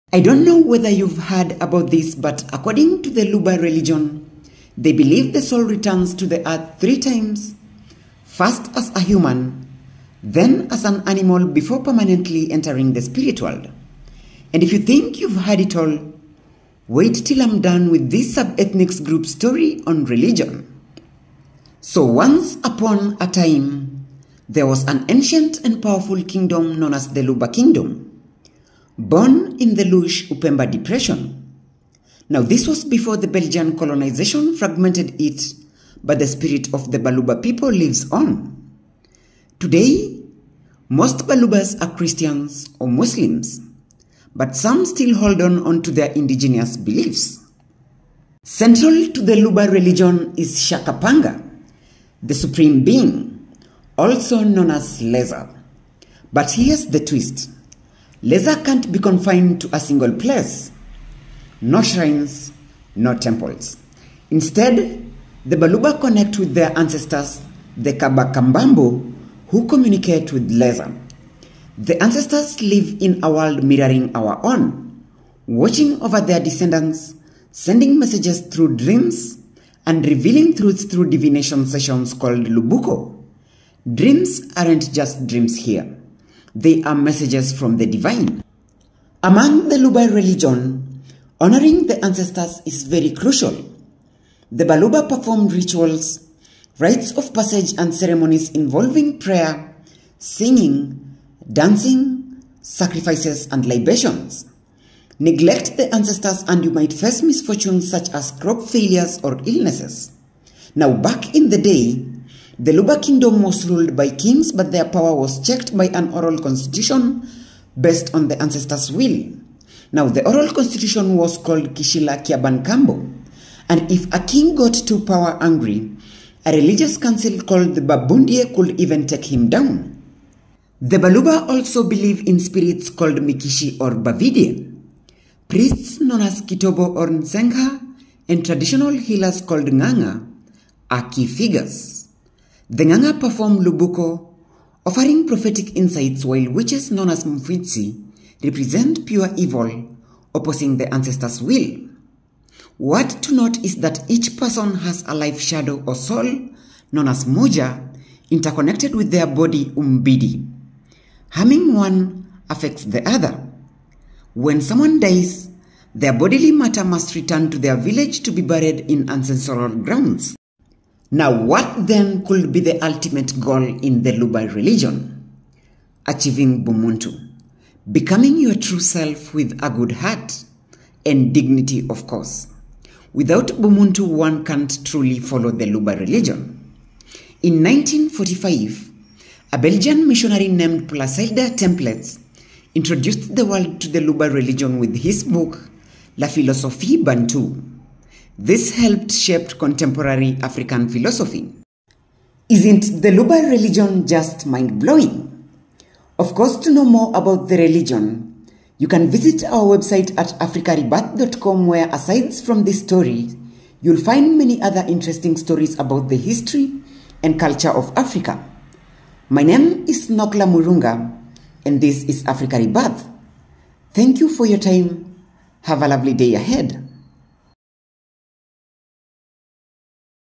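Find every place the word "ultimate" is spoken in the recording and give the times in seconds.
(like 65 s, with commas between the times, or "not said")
172 s.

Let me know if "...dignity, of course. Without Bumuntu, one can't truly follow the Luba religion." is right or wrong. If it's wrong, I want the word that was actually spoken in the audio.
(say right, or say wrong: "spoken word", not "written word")
right.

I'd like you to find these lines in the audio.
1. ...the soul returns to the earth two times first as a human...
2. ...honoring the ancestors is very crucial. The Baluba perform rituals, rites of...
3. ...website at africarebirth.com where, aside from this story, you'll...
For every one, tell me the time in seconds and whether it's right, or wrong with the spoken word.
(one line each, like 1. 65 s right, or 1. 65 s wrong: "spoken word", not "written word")
1. 5 s wrong: "three", not "two"
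2. 91 s right
3. 209 s right.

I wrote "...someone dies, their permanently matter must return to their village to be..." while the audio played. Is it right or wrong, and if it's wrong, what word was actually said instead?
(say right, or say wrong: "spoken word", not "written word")
wrong: "bodily", not "permanently".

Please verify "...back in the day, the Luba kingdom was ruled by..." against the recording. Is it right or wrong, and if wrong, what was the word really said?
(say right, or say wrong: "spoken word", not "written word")
right.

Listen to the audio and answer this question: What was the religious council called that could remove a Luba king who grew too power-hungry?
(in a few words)
Babundie.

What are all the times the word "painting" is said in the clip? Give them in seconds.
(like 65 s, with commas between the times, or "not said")
not said.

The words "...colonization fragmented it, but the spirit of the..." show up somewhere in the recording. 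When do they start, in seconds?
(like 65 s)
33 s.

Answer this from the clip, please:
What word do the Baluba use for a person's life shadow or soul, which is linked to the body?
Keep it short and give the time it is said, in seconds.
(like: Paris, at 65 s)
Moja, at 157 s.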